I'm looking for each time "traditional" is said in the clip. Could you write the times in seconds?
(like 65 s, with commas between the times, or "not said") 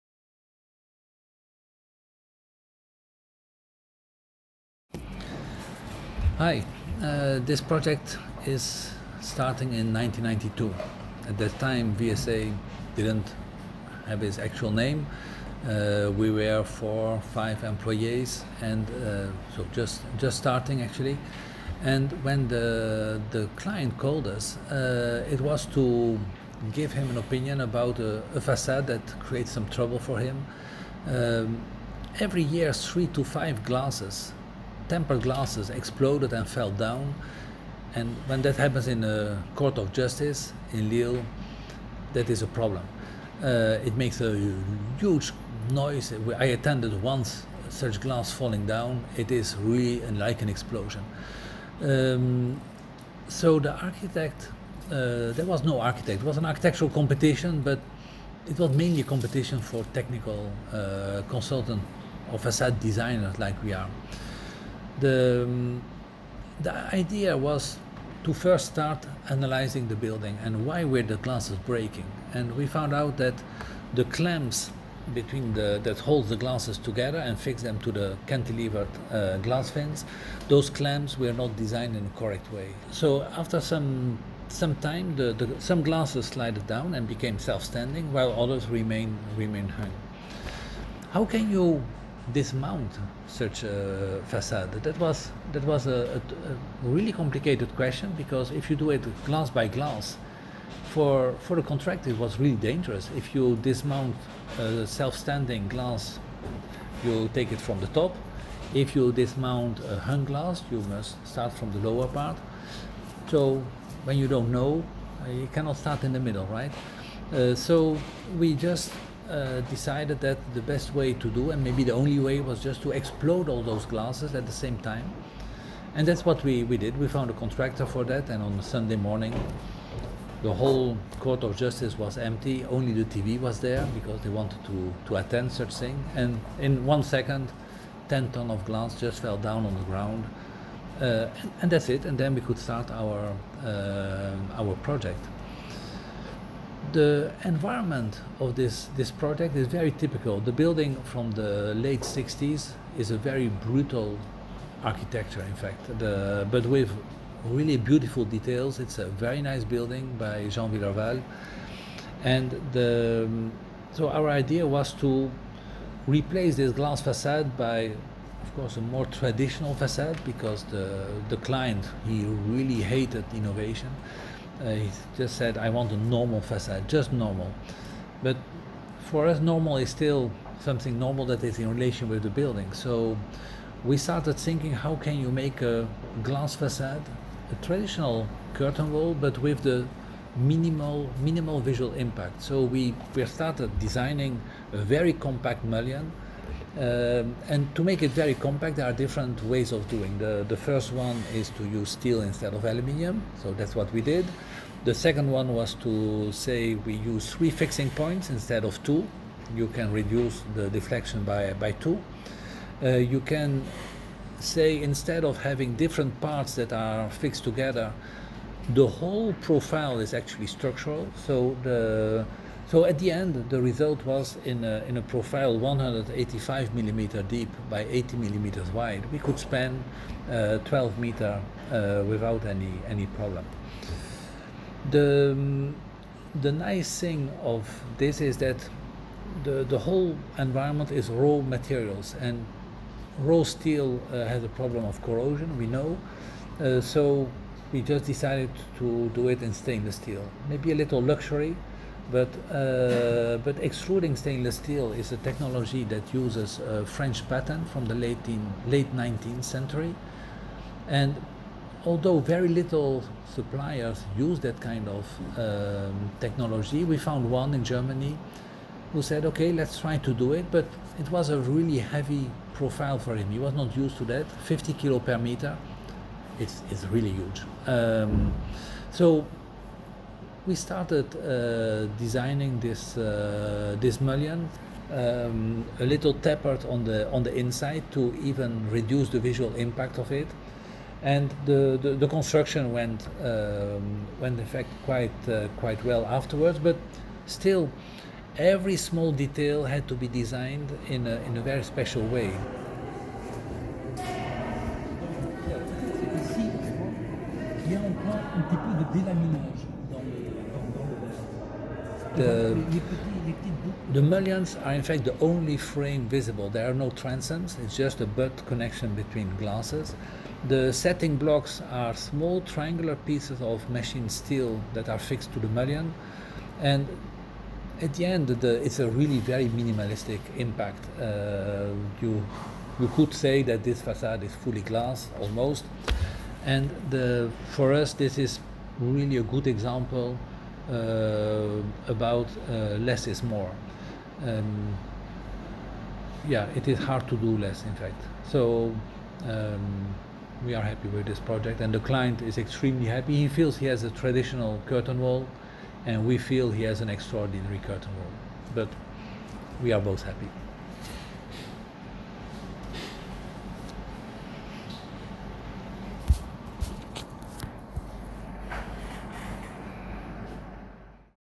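169 s, 187 s, 353 s.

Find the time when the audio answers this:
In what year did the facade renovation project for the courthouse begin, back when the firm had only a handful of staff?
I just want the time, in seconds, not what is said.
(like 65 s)
9 s.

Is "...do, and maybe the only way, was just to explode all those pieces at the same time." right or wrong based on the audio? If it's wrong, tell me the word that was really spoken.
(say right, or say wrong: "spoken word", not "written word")
wrong: "glasses", not "pieces".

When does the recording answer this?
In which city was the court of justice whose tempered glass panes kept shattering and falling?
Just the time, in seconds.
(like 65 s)
40 s.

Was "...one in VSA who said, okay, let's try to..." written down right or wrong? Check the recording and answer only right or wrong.
wrong.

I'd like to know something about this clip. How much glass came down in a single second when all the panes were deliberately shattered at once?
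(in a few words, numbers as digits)
10 tons.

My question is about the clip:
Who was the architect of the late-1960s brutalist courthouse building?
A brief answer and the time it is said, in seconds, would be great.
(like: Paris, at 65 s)
Jean Willerval, at 160 s.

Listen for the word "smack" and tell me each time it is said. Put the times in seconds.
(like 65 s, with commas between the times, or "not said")
not said.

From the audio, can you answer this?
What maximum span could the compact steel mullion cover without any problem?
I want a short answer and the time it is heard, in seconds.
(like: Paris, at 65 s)
12 meters, at 230 s.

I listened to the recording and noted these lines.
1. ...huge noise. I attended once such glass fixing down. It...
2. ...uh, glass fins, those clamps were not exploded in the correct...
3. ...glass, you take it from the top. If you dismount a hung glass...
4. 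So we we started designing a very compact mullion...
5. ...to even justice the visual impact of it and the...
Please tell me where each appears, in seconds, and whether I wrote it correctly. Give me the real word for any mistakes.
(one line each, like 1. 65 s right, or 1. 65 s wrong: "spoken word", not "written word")
1. 44 s wrong: "falling", not "fixing"
2. 79 s wrong: "designed", not "exploded"
3. 105 s right
4. 192 s right
5. 287 s wrong: "reduce", not "justice".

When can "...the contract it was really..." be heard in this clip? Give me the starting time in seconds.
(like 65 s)
101 s.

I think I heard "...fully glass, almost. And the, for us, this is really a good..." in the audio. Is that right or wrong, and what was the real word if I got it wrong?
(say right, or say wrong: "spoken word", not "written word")
right.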